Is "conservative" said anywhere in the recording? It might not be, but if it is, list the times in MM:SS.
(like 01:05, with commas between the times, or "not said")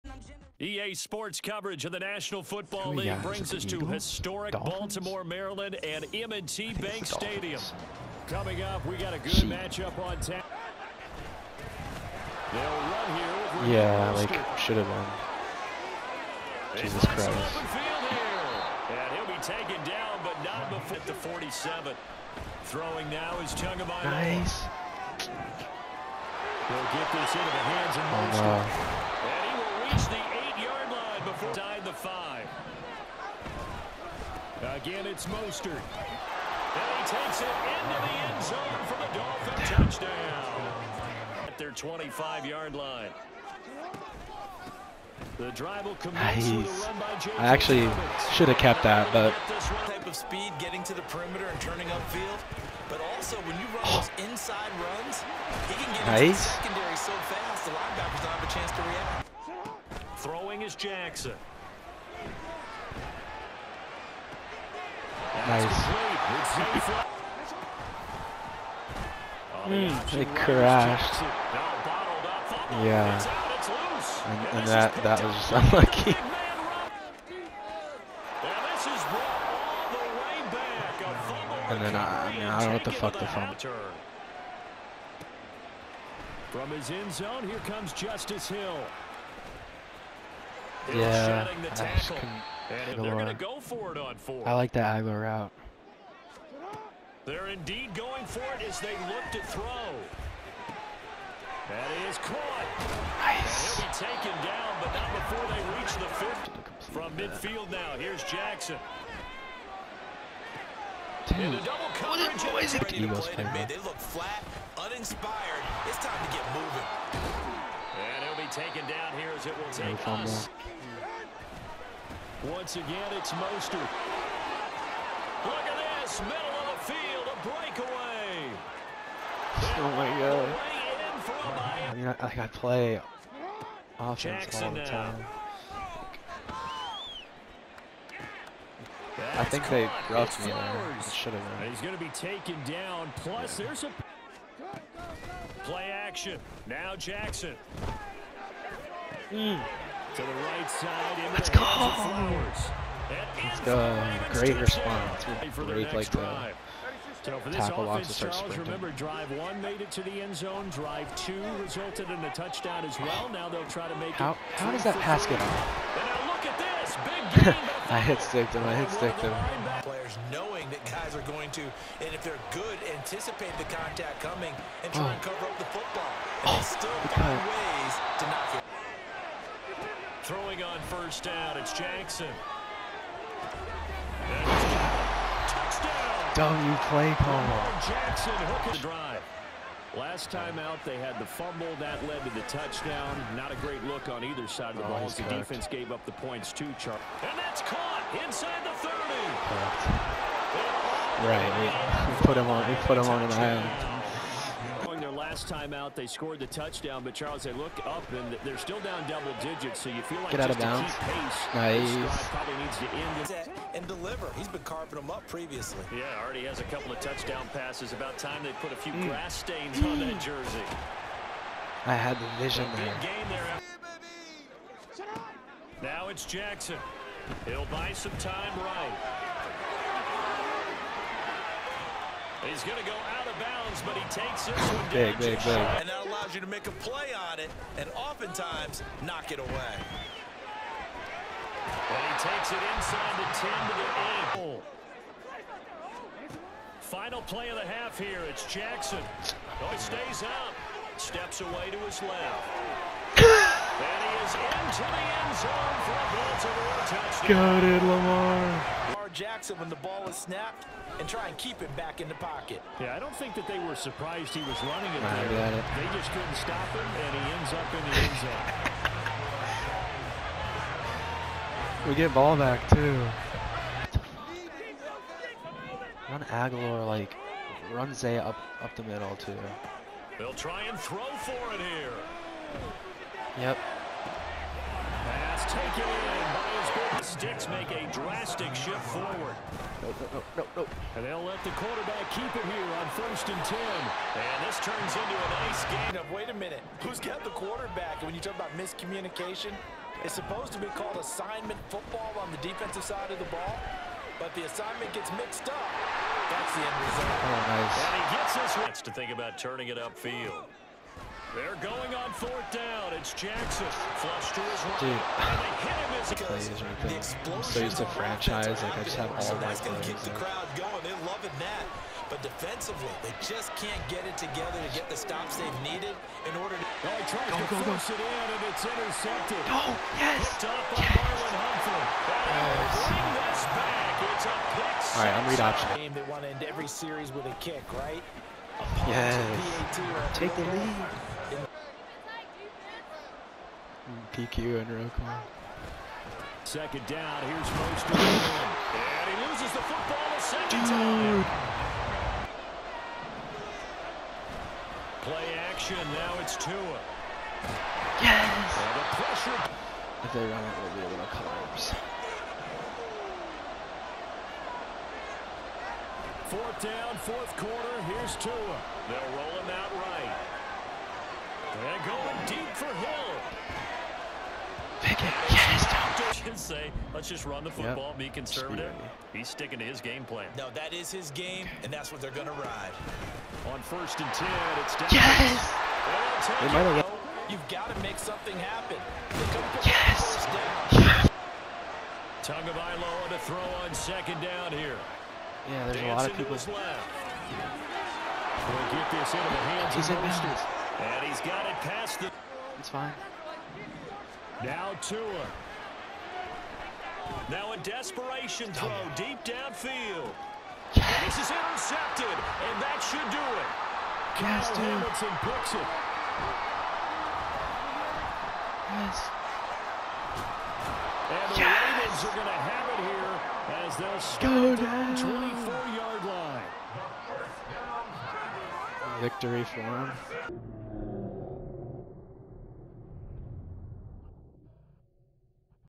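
06:18.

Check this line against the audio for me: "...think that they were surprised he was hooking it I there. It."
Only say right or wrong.
wrong.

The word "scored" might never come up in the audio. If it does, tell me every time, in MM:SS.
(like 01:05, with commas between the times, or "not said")
03:26.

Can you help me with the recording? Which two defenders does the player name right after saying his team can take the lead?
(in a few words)
PQ and Roquan.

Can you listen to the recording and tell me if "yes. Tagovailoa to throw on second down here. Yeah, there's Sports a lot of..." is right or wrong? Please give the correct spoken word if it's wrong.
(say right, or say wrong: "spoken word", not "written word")
wrong: "Dancing", not "Sports".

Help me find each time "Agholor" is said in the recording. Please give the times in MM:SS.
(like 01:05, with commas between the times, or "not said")
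01:35, 04:36.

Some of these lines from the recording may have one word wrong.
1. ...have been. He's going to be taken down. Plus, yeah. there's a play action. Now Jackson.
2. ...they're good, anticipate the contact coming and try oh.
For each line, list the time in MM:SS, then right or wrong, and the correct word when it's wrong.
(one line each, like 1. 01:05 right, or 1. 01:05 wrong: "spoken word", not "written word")
1. 02:21 right
2. 02:52 right.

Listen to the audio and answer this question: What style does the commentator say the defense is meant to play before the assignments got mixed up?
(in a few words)
assignment football.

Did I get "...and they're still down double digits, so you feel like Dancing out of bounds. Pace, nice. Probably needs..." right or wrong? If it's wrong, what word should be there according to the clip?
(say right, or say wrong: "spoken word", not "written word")
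wrong: "Get", not "Dancing".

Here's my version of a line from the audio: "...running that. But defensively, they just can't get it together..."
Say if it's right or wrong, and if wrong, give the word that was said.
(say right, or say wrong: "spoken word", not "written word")
wrong: "loving", not "running".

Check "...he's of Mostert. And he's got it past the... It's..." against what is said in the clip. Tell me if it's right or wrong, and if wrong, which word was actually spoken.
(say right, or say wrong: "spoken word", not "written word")
right.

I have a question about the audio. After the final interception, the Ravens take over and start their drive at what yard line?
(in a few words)
24.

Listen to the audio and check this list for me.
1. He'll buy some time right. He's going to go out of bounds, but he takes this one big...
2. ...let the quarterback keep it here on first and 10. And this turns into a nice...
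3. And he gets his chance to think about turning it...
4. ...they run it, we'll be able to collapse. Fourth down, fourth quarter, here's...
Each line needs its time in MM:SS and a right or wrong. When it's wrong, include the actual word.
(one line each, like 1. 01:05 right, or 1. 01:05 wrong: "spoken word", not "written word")
1. 03:47 right
2. 04:51 right
3. 05:07 right
4. 06:00 right.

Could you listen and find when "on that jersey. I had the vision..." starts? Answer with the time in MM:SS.
03:39.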